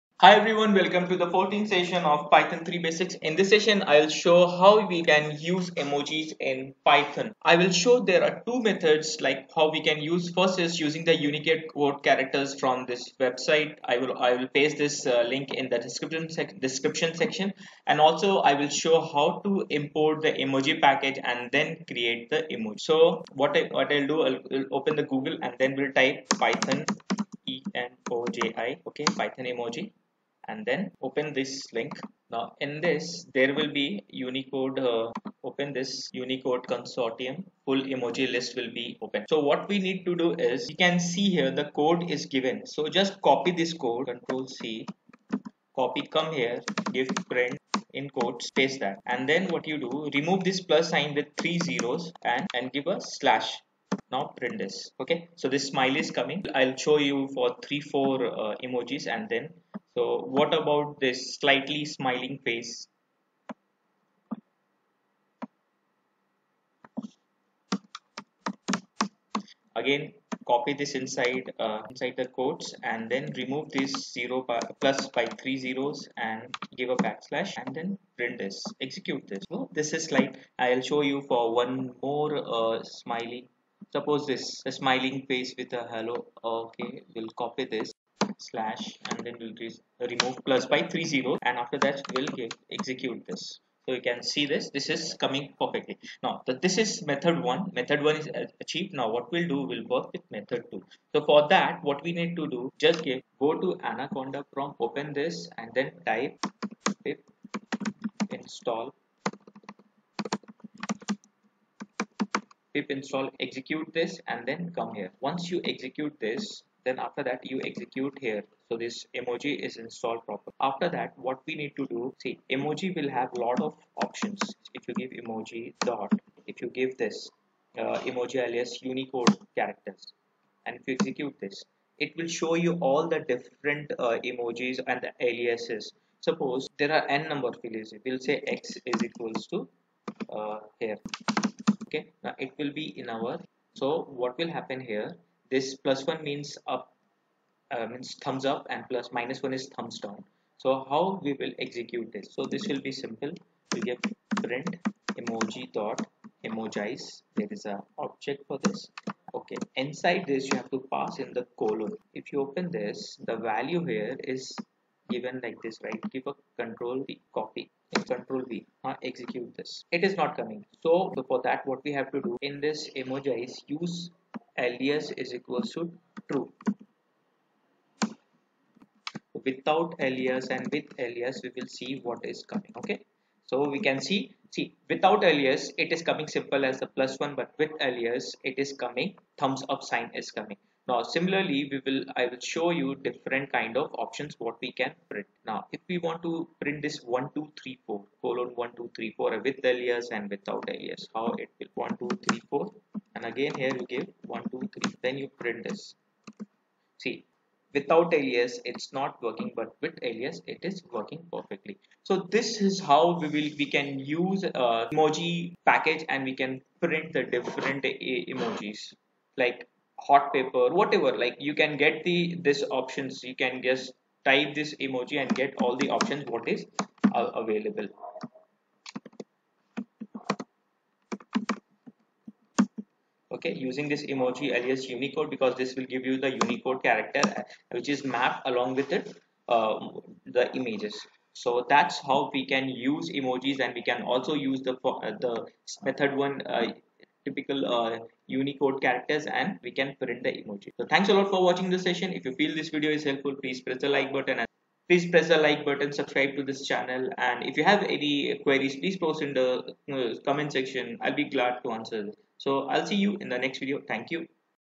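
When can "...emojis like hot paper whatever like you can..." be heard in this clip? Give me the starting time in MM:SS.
03:37.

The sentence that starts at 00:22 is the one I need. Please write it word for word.
So what I what I'll do, I'll, I'll open the Google and then we'll type Python E N O J I.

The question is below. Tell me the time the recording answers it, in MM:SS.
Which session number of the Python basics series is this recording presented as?
00:01.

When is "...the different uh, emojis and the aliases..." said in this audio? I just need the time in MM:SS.
02:13.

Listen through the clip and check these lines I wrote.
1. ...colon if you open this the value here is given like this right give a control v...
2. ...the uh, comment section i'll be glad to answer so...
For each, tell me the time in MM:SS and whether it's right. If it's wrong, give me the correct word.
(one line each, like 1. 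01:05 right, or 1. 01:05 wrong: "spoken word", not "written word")
1. 02:41 right
2. 04:19 right.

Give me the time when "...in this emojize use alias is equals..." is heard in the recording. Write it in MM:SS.
02:52.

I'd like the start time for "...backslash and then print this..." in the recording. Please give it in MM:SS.
01:16.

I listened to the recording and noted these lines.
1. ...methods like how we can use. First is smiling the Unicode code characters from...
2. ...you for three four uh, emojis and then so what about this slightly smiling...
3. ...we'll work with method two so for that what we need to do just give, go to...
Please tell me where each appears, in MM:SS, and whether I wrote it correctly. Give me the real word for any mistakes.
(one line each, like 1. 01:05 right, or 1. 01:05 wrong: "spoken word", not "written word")
1. 00:08 wrong: "using", not "smiling"
2. 00:56 right
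3. 01:39 right.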